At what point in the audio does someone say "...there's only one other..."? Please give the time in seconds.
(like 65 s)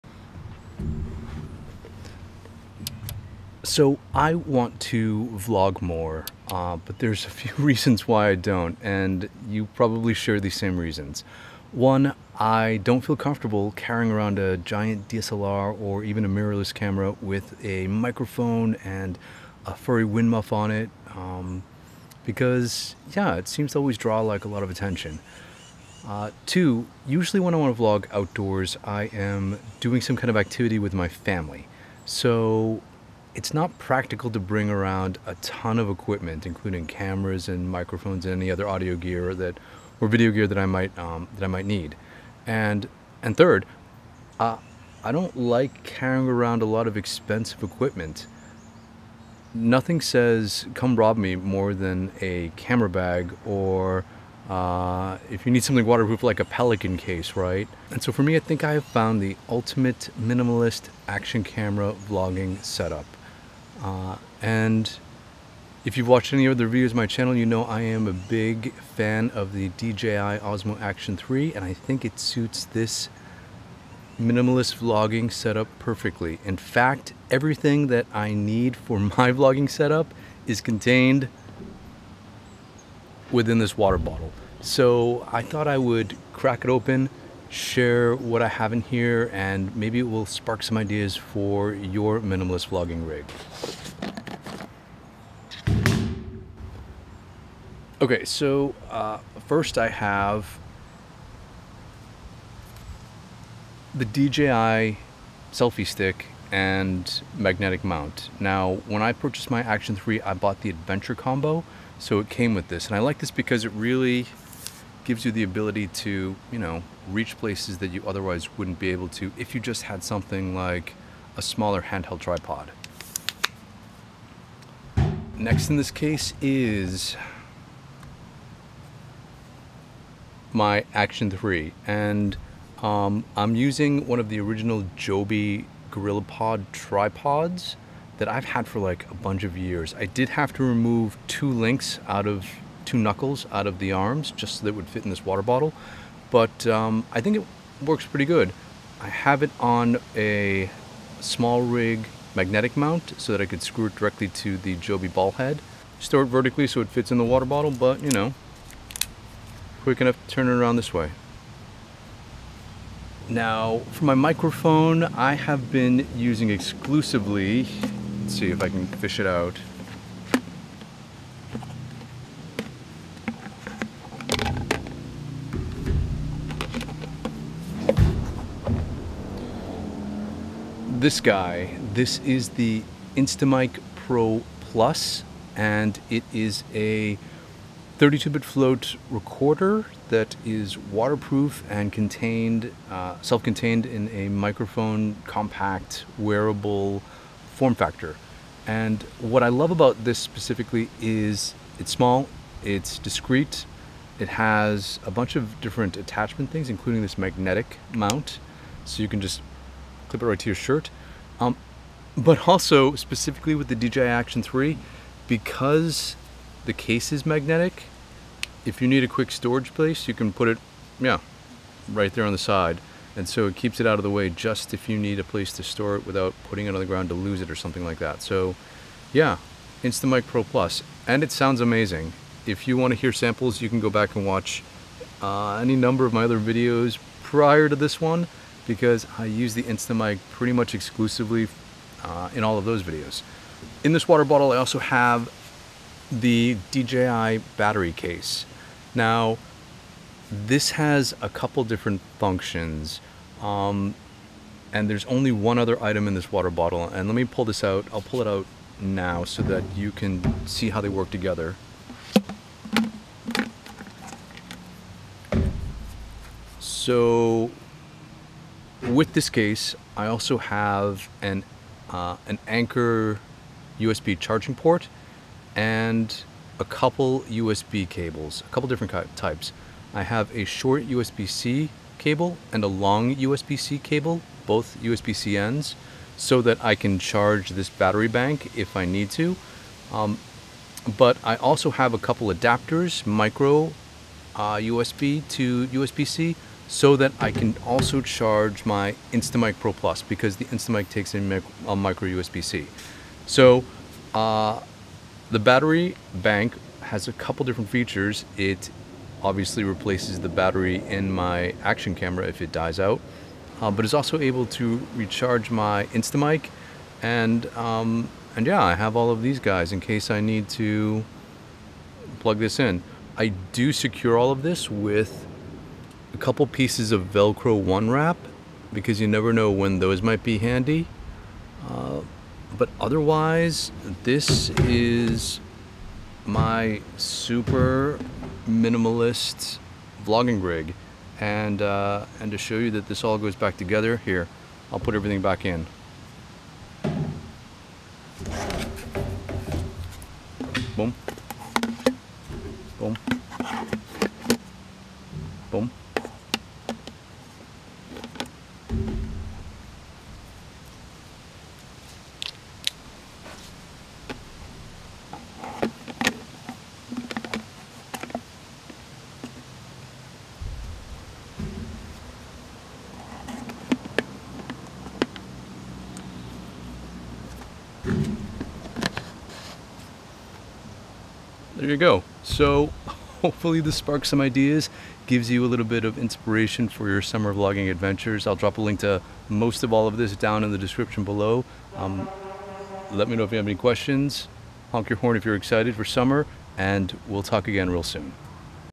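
254 s.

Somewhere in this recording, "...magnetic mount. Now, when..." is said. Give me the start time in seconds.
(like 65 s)
107 s.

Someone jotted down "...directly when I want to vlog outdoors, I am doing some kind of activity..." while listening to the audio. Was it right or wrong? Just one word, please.
wrong.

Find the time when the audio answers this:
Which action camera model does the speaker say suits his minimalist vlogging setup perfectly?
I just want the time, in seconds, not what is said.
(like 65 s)
69 s.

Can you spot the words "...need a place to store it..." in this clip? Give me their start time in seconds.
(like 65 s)
224 s.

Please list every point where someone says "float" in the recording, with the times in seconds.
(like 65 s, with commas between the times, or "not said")
188 s.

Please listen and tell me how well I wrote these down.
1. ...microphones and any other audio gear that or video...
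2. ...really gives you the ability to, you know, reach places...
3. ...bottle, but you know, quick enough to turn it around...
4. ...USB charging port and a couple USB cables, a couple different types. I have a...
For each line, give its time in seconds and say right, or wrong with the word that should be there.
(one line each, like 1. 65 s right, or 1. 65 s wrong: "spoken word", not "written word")
1. 37 s right
2. 113 s right
3. 157 s right
4. 273 s right.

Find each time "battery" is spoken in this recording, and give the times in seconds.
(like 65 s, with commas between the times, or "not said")
247 s, 287 s, 305 s, 310 s.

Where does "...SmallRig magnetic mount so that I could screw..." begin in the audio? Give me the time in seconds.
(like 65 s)
151 s.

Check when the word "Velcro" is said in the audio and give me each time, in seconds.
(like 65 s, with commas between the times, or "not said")
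327 s.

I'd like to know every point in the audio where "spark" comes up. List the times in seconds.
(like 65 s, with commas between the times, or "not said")
90 s, 383 s.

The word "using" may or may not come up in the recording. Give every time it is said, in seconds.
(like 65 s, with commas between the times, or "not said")
133 s, 166 s.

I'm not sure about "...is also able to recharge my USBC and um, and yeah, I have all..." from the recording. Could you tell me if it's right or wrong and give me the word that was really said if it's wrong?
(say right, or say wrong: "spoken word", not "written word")
wrong: "Instamic", not "USBC".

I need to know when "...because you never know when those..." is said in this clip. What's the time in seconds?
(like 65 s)
328 s.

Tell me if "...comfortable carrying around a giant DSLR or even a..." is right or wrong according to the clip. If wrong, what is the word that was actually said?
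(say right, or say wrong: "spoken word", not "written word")
right.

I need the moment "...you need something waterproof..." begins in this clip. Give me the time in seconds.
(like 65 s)
55 s.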